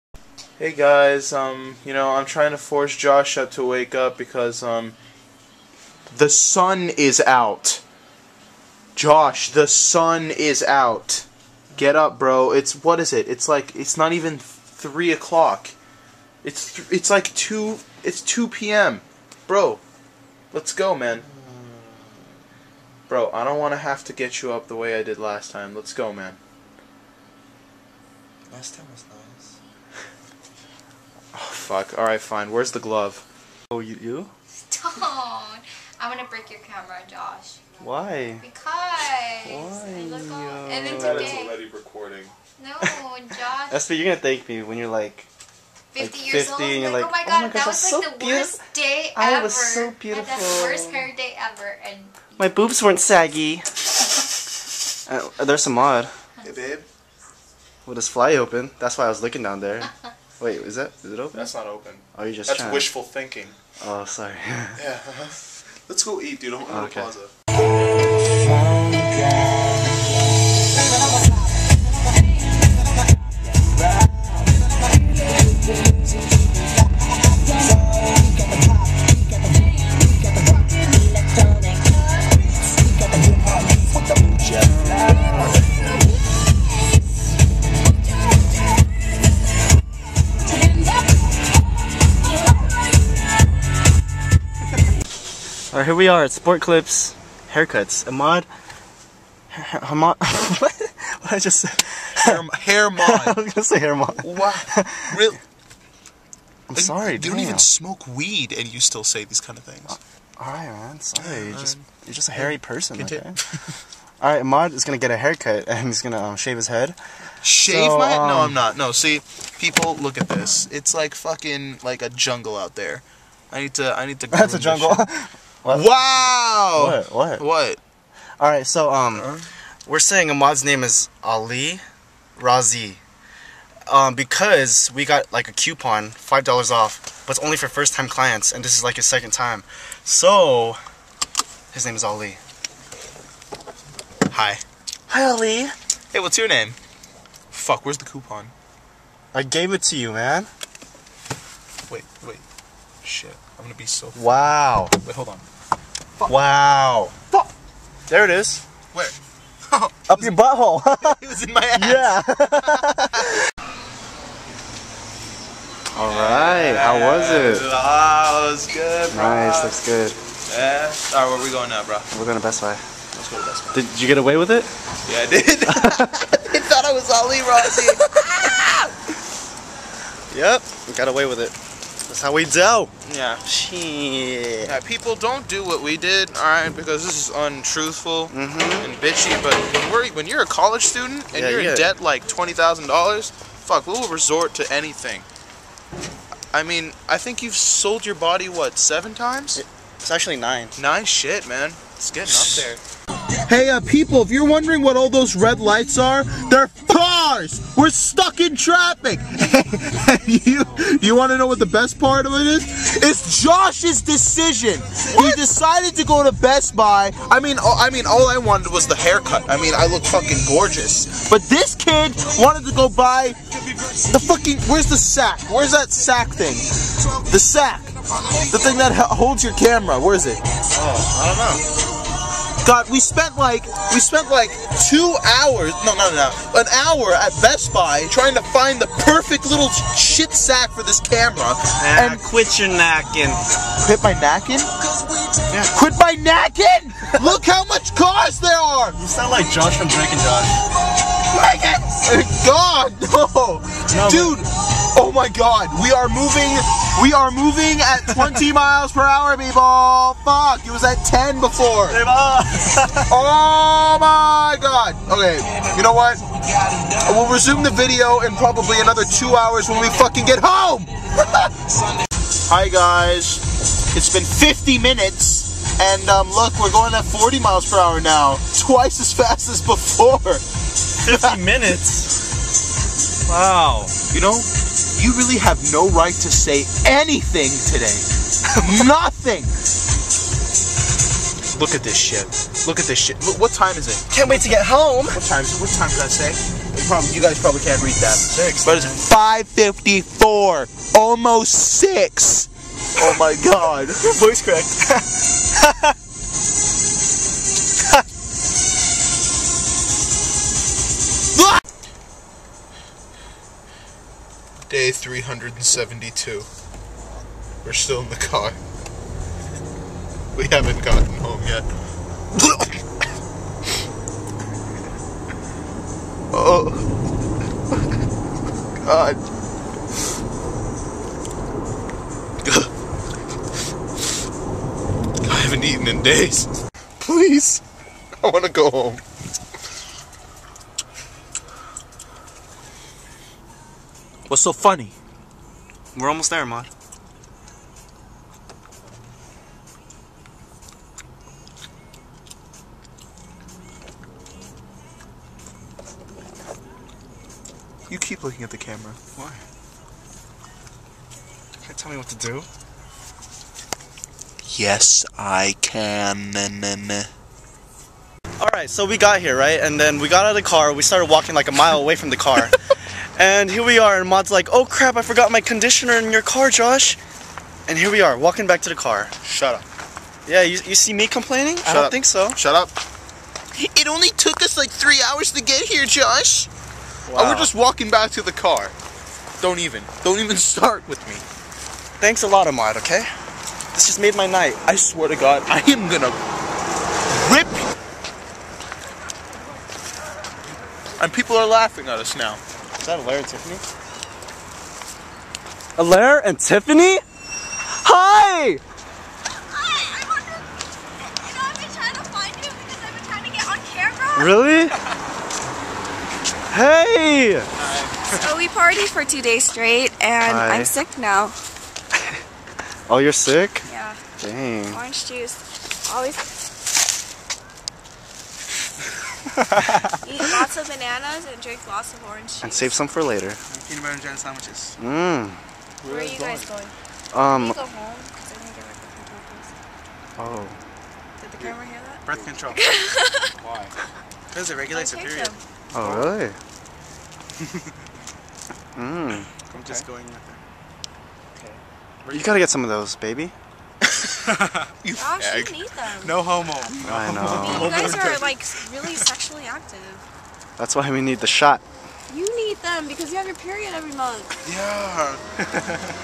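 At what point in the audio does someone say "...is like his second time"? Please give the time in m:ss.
2:18.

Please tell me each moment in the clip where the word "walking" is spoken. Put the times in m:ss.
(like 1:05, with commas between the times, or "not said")
6:11, 6:18, 6:27.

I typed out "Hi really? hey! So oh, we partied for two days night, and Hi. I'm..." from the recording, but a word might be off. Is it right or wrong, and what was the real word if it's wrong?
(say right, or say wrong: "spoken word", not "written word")
wrong: "straight", not "night".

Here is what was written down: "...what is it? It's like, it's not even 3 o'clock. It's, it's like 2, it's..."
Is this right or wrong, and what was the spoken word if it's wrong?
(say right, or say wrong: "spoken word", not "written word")
right.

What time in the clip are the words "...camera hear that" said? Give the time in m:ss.
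7:21.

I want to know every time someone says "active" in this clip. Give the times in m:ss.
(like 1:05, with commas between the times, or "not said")
7:39.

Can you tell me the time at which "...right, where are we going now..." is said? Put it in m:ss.
2:50.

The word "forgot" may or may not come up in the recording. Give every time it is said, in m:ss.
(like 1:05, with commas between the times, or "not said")
6:15.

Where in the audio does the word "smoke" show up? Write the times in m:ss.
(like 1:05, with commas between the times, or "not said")
1:47.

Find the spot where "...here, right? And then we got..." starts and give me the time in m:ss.
6:09.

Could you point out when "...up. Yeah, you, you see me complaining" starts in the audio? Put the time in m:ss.
6:19.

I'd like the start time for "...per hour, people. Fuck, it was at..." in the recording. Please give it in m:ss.
4:18.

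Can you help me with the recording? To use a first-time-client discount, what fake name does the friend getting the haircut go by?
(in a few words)
Ali Razi.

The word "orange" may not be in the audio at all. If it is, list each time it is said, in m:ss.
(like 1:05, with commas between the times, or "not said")
7:04, 7:12.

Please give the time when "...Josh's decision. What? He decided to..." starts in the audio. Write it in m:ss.
3:33.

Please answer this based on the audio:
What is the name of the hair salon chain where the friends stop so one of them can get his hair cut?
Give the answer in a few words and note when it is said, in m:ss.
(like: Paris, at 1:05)
Sport Clips, at 1:36.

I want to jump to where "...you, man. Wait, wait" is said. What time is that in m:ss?
2:29.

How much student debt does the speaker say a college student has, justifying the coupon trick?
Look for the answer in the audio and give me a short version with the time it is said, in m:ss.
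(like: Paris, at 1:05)
$20,000, at 3:12.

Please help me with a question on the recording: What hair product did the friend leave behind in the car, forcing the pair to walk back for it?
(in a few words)
Conditioner.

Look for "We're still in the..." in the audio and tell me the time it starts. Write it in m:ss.
5:17.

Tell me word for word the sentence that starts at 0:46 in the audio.
And you're like, oh, oh my god, oh my gosh, that was so like the worst day ever.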